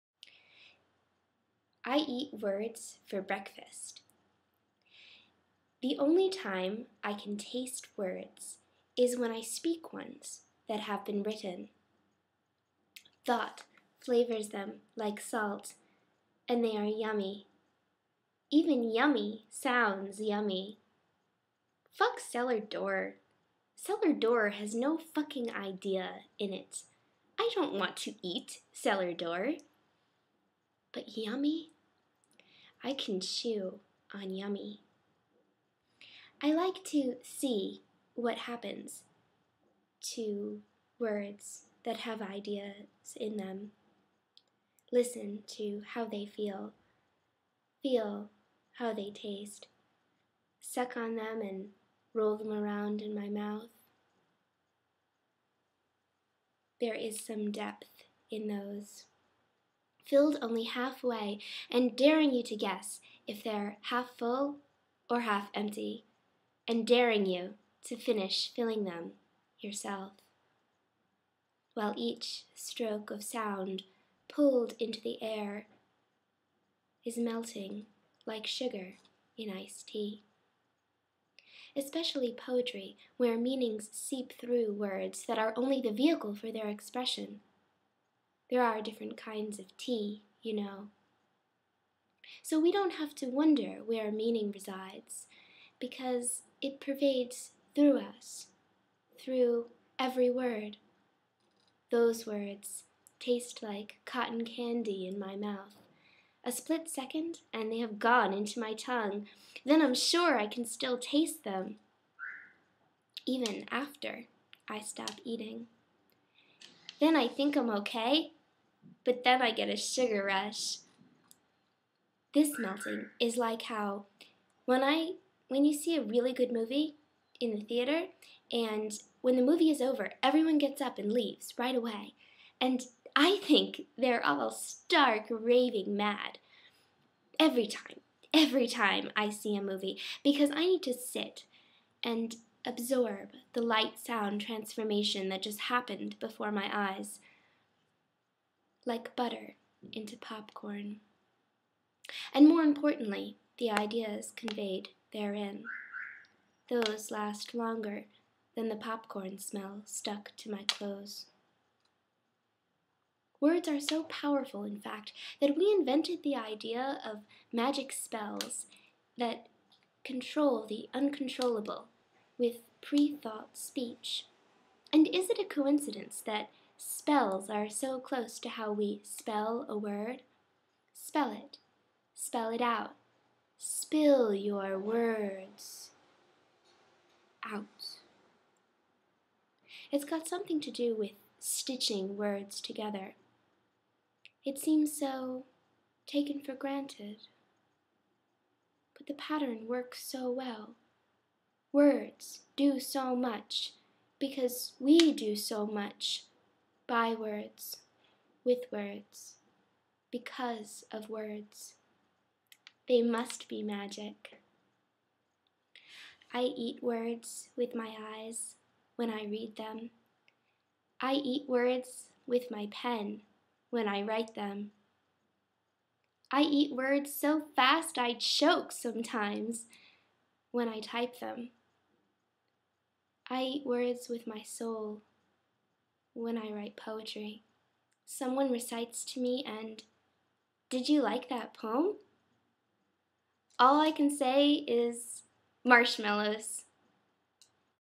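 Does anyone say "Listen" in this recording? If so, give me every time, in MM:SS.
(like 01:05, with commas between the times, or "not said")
00:44.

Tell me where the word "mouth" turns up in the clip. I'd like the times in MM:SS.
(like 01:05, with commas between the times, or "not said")
00:53, 01:45.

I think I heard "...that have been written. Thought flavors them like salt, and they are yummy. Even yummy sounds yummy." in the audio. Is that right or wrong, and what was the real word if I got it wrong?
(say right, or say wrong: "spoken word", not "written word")
right.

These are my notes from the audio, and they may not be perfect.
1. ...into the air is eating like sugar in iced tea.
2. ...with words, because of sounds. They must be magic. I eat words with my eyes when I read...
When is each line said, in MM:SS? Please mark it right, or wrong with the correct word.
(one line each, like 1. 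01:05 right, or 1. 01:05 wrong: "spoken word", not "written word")
1. 01:14 wrong: "melting", not "eating"
2. 03:28 wrong: "words", not "sounds".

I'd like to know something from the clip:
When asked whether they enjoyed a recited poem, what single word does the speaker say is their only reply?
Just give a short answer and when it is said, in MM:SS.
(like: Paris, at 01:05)
marshmallows, at 04:05.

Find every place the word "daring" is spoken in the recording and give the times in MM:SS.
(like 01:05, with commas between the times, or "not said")
01:01, 01:06.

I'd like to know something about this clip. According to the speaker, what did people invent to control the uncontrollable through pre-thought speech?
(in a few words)
magic spells.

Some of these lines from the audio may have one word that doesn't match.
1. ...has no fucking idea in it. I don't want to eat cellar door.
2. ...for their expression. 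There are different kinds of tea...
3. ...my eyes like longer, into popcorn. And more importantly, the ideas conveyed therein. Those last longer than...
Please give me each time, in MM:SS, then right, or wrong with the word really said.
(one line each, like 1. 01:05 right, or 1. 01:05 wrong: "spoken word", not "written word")
1. 00:24 right
2. 01:26 right
3. 02:26 wrong: "butter", not "longer".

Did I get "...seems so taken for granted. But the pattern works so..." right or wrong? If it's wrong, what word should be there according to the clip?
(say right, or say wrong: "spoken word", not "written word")
right.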